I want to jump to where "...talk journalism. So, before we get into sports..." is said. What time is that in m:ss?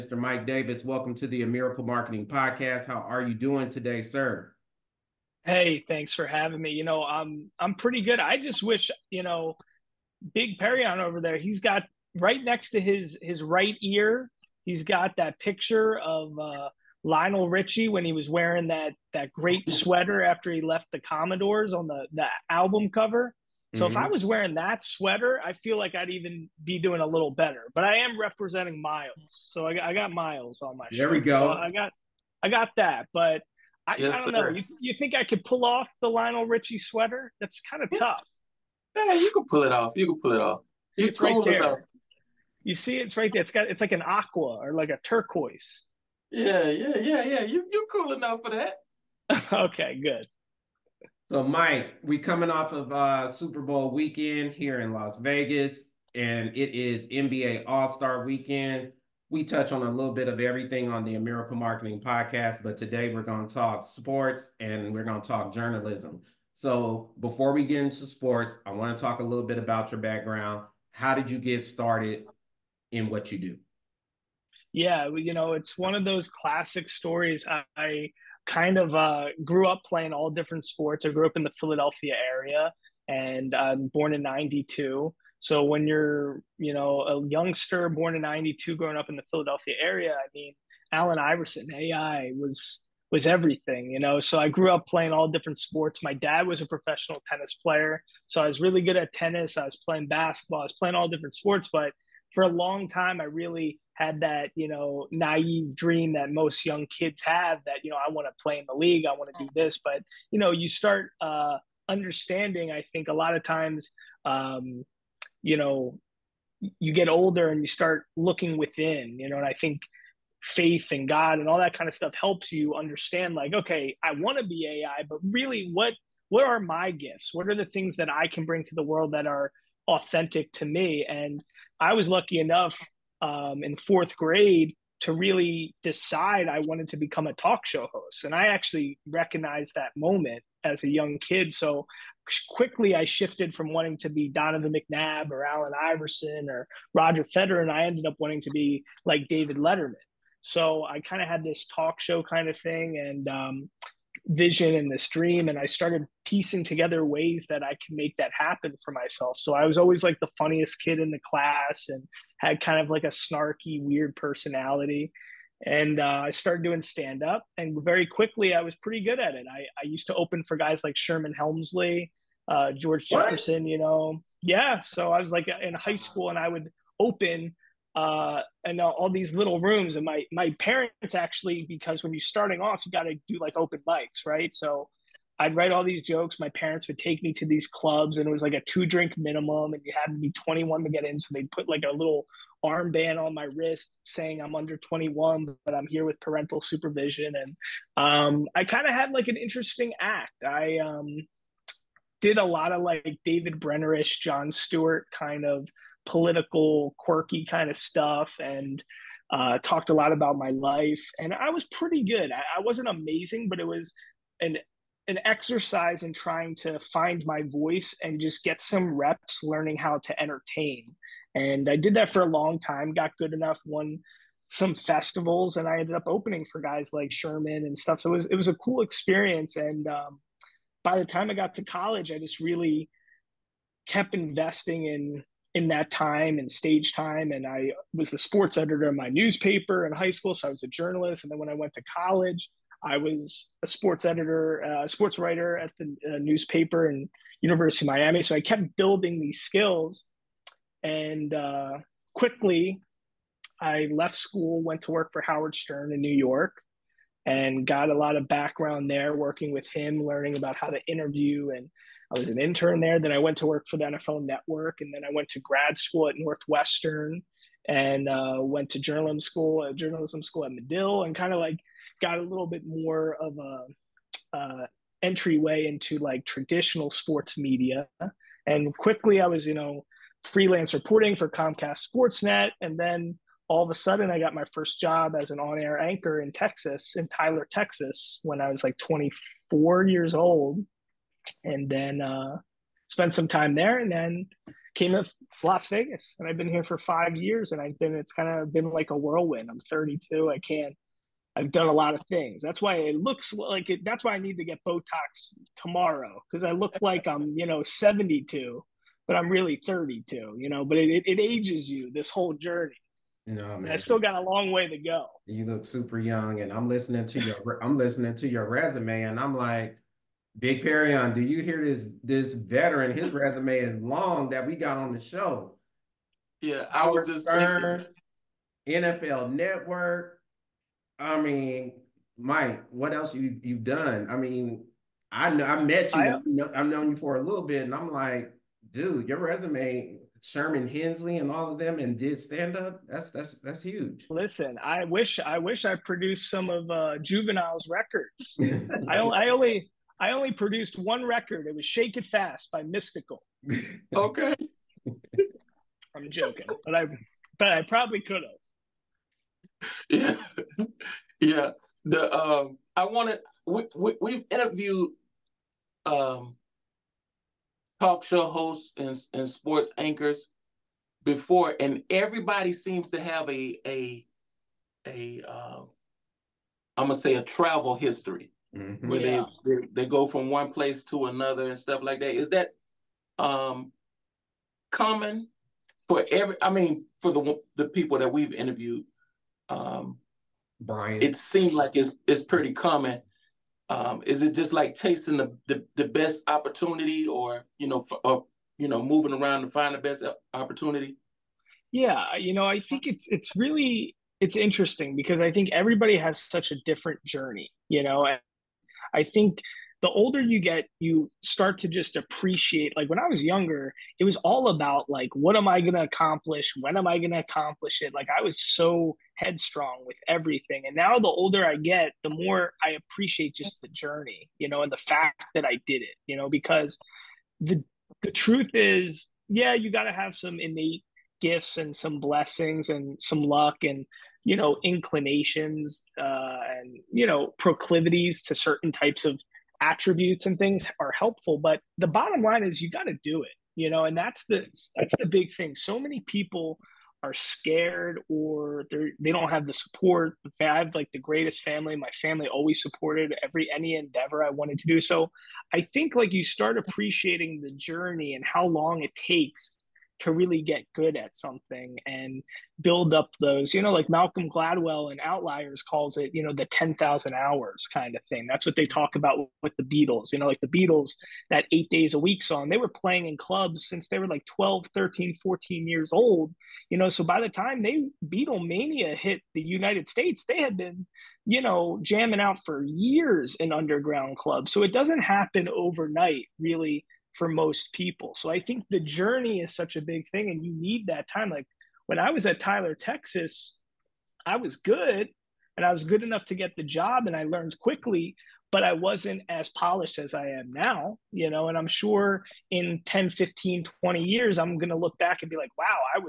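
1:05.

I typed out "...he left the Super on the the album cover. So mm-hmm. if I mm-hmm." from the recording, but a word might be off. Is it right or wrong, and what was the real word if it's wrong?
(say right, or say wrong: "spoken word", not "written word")
wrong: "Commodores", not "Super".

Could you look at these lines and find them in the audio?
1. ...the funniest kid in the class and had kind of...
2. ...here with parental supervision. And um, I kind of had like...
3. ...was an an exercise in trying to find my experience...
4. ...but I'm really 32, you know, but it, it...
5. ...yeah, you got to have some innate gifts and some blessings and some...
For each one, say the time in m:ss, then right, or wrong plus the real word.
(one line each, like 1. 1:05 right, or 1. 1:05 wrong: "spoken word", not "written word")
1. 2:40 right
2. 3:15 right
3. 3:33 wrong: "voice", not "experience"
4. 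5:09 right
5. 7:09 right.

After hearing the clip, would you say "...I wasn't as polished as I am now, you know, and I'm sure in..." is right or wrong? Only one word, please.
right.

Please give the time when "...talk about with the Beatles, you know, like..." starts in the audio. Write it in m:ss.
7:48.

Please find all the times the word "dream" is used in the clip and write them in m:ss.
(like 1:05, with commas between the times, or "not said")
1:45, 2:35.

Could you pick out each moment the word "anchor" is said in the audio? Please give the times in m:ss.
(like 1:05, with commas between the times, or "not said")
4:45, 6:09.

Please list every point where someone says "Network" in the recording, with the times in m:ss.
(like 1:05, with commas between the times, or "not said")
4:24, 5:29.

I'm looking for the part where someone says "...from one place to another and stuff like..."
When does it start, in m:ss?
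6:20.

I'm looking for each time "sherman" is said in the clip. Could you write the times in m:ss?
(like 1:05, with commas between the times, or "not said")
2:50, 3:47, 5:40.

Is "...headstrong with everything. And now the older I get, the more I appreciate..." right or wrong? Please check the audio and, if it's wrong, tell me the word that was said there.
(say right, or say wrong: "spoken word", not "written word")
right.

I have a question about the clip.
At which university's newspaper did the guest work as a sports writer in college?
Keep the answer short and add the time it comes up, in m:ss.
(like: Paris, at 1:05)
University of Miami, at 4:07.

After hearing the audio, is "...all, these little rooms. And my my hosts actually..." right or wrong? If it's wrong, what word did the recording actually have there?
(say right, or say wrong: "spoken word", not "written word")
wrong: "parents", not "hosts".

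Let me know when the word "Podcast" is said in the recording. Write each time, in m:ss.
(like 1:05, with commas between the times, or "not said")
0:02, 1:02.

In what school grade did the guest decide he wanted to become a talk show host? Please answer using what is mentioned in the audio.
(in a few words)
Fourth grade.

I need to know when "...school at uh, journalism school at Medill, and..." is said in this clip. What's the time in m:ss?
4:29.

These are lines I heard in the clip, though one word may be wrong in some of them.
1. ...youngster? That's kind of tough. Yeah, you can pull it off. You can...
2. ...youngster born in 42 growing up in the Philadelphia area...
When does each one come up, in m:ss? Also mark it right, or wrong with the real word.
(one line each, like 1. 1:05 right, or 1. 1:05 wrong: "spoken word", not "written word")
1. 0:36 wrong: "sweater", not "youngster"
2. 1:27 wrong: "92", not "42".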